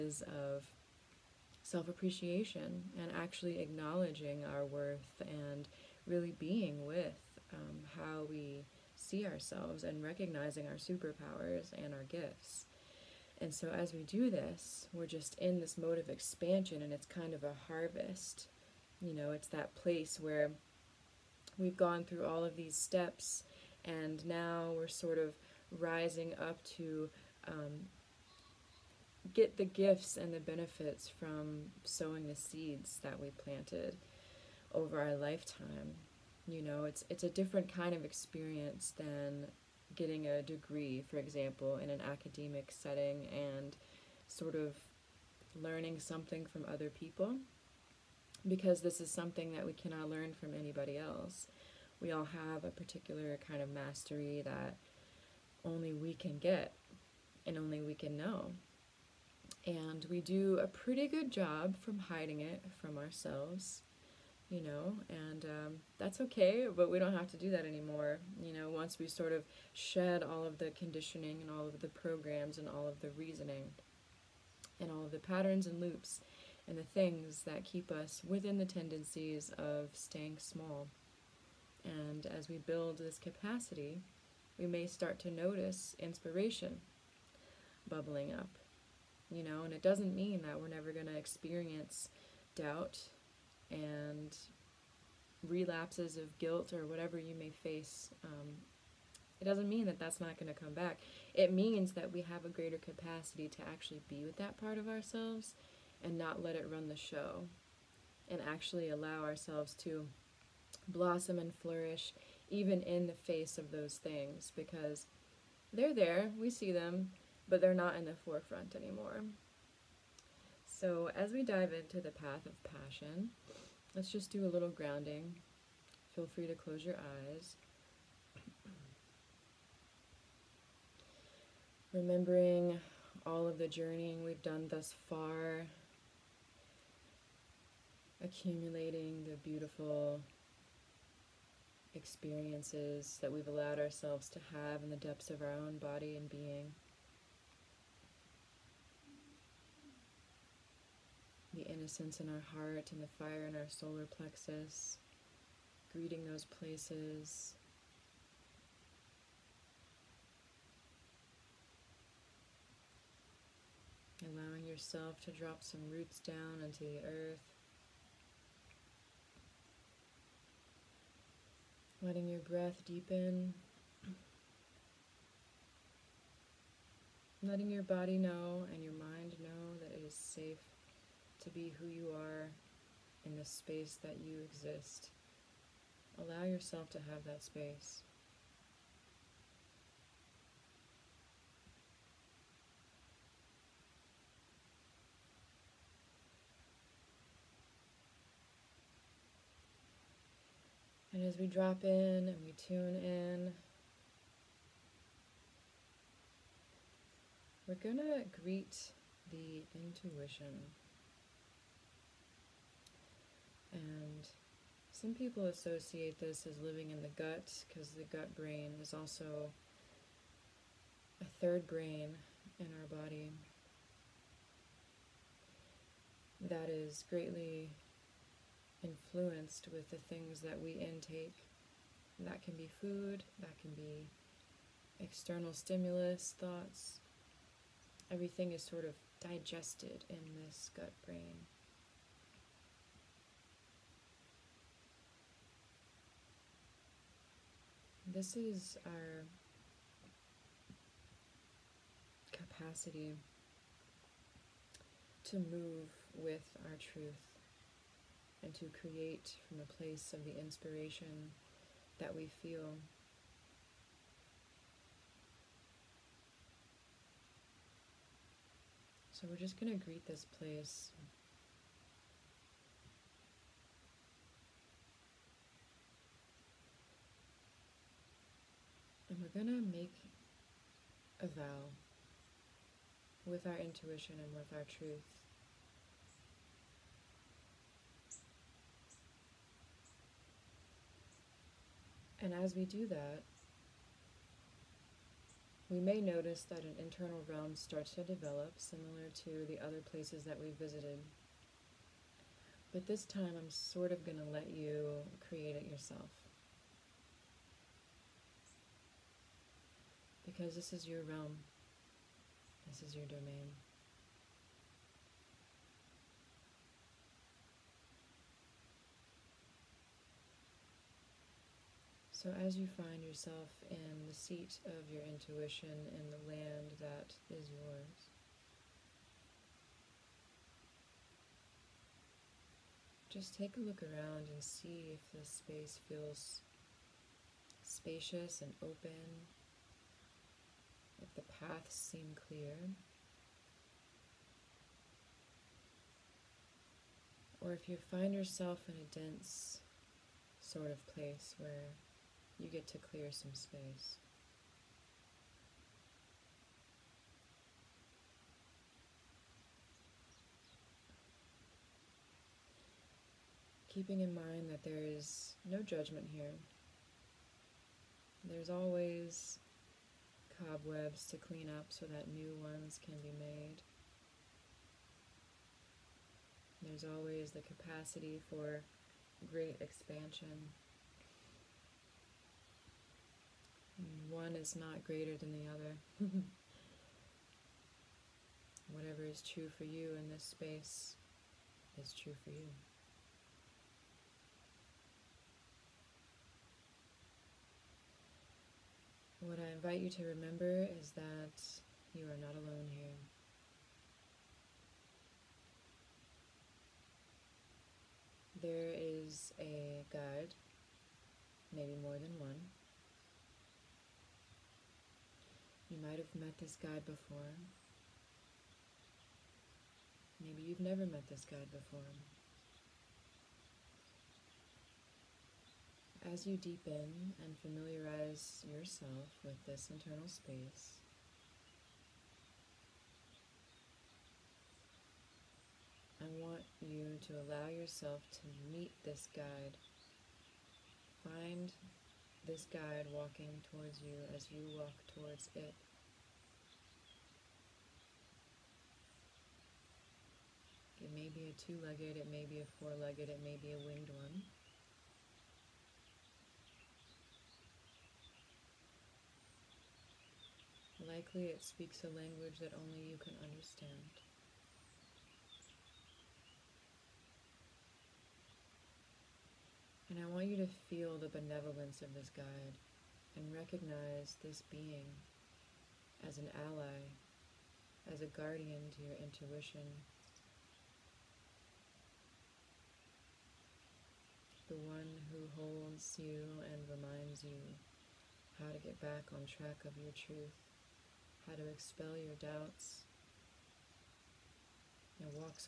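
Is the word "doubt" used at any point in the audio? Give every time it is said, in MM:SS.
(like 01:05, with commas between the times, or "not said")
01:32, 08:12.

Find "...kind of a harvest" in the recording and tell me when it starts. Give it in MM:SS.
00:17.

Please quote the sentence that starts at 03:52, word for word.
And that can be food, that can be external stimulus, thoughts.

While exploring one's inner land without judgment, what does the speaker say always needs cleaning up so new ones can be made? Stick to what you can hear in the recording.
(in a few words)
cobwebs.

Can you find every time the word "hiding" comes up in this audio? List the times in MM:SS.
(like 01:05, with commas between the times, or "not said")
01:01.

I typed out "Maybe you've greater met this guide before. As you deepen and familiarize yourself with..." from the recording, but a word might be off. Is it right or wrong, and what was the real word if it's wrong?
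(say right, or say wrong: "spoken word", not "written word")
wrong: "never", not "greater".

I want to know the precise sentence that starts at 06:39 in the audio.
what I invite you to remember is that you are not alone here.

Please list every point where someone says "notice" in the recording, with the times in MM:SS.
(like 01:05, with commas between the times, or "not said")
01:25, 04:56.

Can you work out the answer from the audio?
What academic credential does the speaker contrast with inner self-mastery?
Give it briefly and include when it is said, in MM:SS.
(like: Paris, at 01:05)
a degree, at 00:39.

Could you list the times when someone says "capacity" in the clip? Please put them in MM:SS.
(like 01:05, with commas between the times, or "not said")
01:23, 01:42, 04:12, 06:17.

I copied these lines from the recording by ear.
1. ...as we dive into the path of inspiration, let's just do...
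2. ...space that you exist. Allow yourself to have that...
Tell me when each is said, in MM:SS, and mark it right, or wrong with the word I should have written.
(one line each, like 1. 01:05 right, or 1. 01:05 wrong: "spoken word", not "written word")
1. 02:01 wrong: "passion", not "inspiration"
2. 03:03 right.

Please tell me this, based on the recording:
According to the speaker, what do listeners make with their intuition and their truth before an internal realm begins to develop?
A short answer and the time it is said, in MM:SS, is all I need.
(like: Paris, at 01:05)
a vow, at 04:41.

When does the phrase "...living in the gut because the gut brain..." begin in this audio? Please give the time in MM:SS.
03:36.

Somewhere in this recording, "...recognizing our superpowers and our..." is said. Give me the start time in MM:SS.
00:10.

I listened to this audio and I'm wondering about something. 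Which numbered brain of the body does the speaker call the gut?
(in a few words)
third brain.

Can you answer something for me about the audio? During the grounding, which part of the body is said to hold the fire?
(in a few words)
solar plexus.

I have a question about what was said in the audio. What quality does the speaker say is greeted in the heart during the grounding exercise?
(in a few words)
innocence.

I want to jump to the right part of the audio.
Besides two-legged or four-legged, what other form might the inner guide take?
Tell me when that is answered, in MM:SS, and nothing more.
07:33.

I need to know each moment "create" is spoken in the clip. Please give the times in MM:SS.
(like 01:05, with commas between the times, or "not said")
04:18, 05:05.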